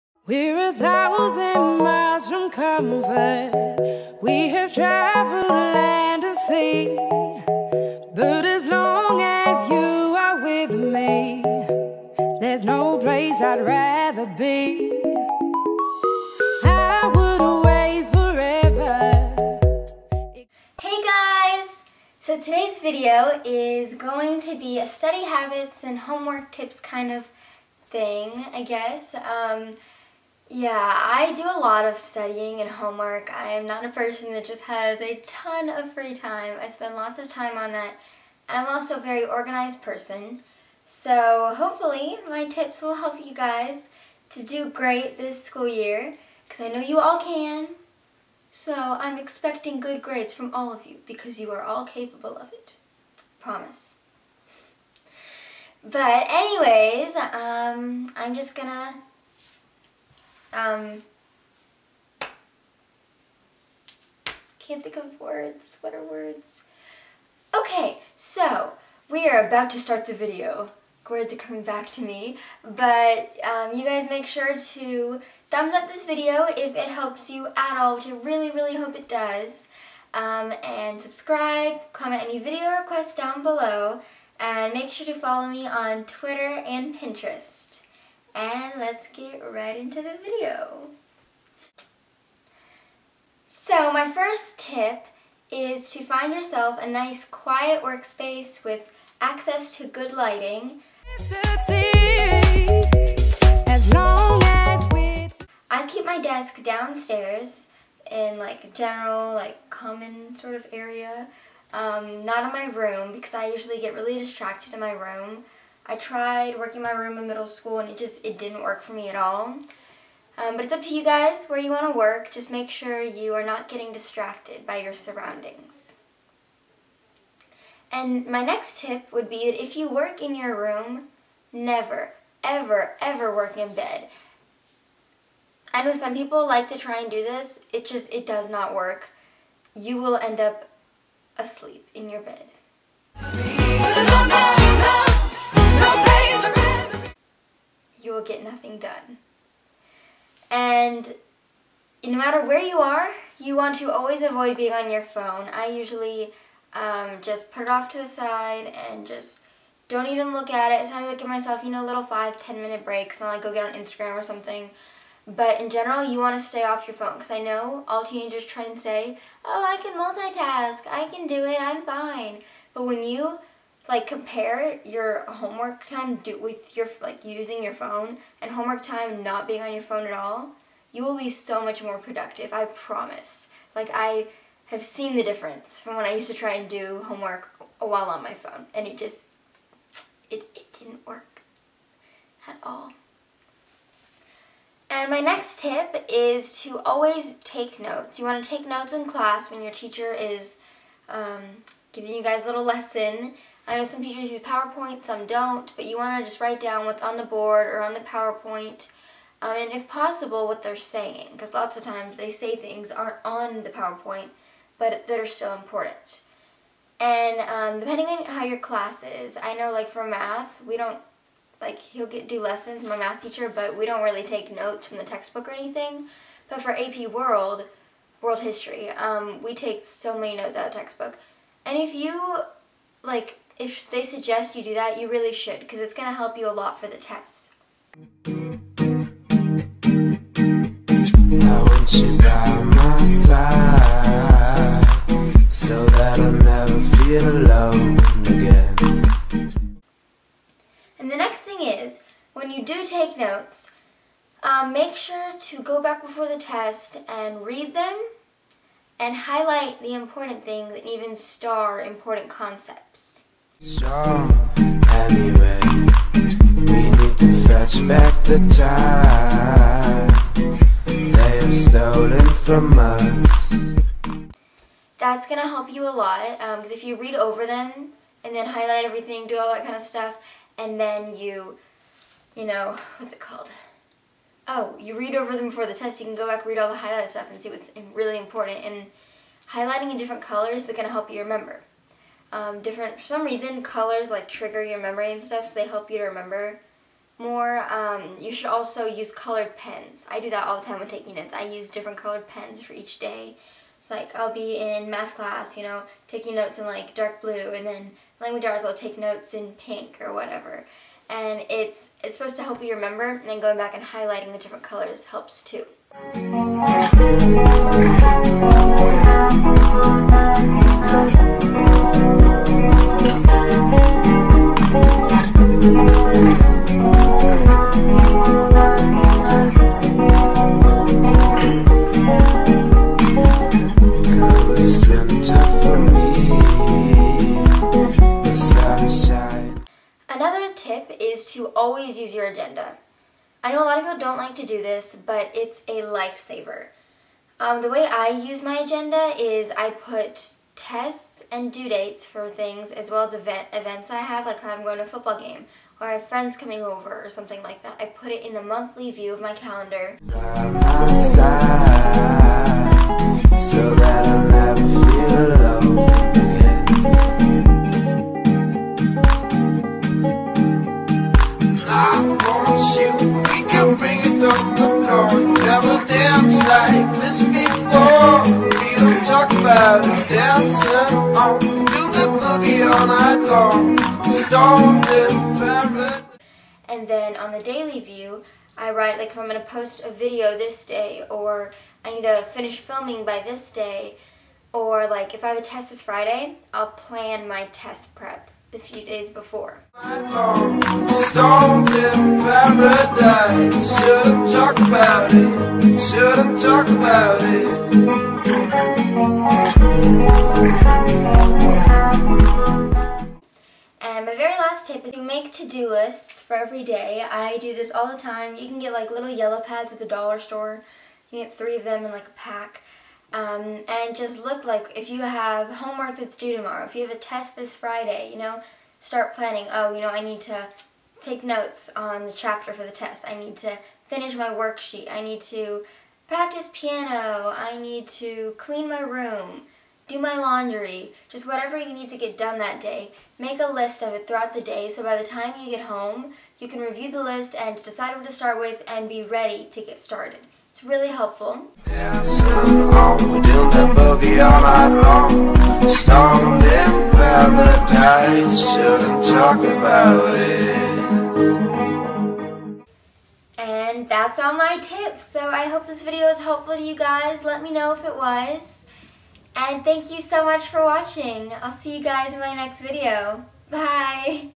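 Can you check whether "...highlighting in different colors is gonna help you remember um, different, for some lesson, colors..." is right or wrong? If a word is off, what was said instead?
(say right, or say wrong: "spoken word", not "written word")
wrong: "reason", not "lesson".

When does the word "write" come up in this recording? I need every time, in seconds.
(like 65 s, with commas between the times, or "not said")
206 s, 388 s.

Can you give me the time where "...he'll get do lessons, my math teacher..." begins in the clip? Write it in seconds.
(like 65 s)
221 s.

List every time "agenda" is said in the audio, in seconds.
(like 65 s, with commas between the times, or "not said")
342 s, 348 s.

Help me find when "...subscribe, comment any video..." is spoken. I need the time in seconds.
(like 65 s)
81 s.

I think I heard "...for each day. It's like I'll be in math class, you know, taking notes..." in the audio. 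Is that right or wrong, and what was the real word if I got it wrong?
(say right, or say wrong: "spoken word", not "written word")
right.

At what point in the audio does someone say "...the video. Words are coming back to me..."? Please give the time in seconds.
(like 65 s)
70 s.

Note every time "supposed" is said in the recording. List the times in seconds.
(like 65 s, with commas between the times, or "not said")
312 s.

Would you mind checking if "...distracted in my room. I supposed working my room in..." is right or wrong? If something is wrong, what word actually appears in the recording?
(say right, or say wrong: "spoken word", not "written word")
wrong: "tried", not "supposed".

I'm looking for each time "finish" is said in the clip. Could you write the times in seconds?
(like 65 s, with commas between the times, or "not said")
392 s, 433 s.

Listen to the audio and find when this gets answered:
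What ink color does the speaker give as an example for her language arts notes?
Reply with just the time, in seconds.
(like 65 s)
309 s.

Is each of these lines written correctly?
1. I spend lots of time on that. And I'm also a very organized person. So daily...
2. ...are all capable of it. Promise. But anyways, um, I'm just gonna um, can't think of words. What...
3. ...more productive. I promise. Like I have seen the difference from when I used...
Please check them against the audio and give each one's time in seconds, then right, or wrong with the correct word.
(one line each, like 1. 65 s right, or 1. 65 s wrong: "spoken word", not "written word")
1. 36 s wrong: "hopefully", not "daily"
2. 51 s right
3. 181 s right.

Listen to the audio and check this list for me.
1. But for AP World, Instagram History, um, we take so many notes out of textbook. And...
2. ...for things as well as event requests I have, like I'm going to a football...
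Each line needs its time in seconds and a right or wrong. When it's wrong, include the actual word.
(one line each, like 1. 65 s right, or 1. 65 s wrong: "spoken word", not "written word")
1. 226 s wrong: "World", not "Instagram"
2. 352 s wrong: "events", not "requests".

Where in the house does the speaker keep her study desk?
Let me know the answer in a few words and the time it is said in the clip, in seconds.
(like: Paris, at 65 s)
Downstairs, at 106 s.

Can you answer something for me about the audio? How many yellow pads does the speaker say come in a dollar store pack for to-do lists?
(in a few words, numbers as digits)
3.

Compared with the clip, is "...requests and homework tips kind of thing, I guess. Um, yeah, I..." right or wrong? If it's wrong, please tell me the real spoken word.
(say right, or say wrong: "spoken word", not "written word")
wrong: "habits", not "requests".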